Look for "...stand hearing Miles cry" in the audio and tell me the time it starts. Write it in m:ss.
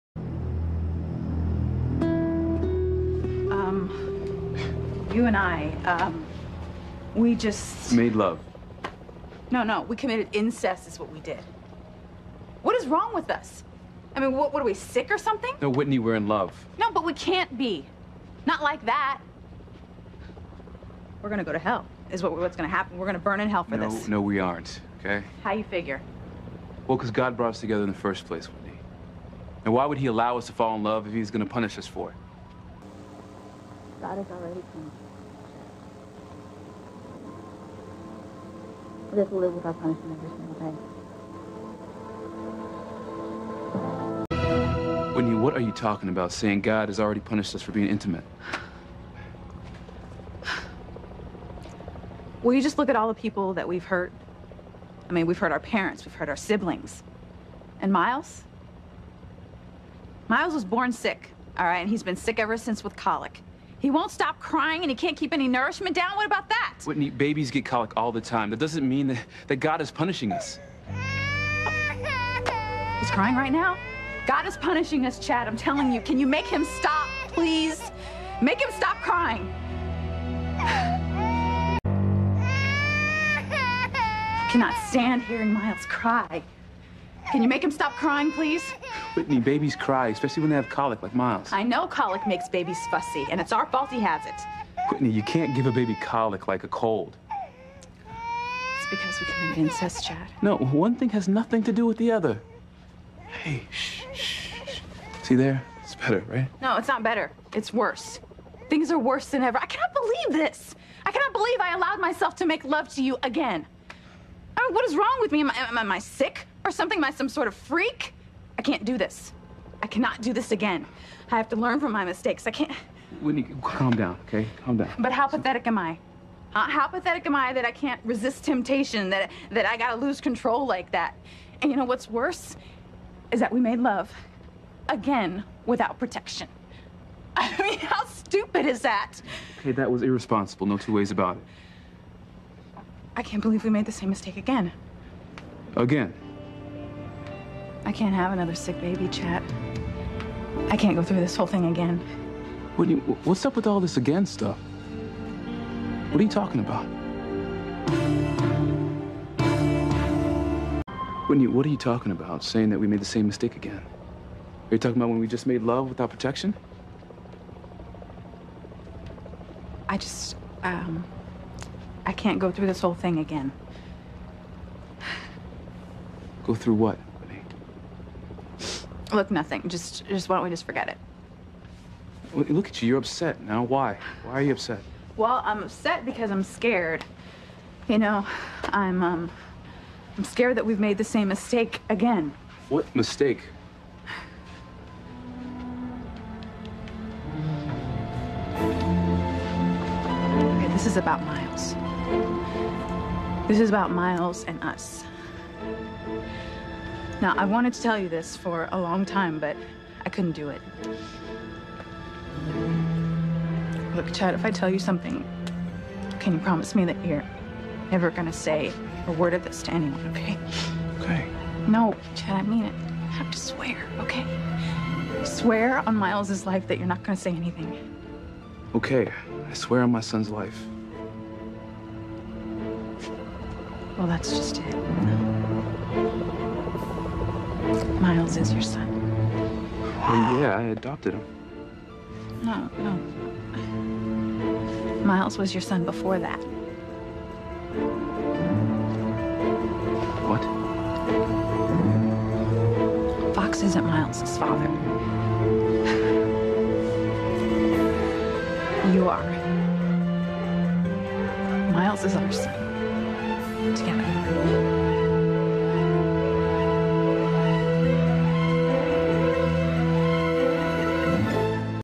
1:24.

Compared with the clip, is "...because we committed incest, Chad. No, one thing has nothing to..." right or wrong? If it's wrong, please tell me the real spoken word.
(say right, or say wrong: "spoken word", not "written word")
right.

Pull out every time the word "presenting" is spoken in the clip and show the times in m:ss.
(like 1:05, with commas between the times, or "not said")
not said.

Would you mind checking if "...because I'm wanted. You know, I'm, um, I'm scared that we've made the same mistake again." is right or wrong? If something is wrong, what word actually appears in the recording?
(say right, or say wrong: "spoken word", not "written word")
wrong: "scared", not "wanted".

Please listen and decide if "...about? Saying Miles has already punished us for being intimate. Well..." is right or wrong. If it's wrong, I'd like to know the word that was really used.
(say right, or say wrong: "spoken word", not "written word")
wrong: "God", not "Miles".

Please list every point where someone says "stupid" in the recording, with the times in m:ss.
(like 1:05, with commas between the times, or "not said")
2:18.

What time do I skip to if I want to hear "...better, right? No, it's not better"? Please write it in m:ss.
1:45.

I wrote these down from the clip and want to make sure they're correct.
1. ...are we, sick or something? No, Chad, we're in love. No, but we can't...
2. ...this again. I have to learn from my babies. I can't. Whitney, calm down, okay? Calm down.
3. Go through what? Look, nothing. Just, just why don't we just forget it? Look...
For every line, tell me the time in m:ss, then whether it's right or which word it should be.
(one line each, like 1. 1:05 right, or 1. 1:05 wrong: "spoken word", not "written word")
1. 0:14 wrong: "Whitney", not "Chad"
2. 2:00 wrong: "mistakes", not "babies"
3. 2:56 right.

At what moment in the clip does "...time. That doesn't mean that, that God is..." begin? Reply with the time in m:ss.
1:08.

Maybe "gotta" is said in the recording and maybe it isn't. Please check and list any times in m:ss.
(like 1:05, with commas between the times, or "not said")
2:09.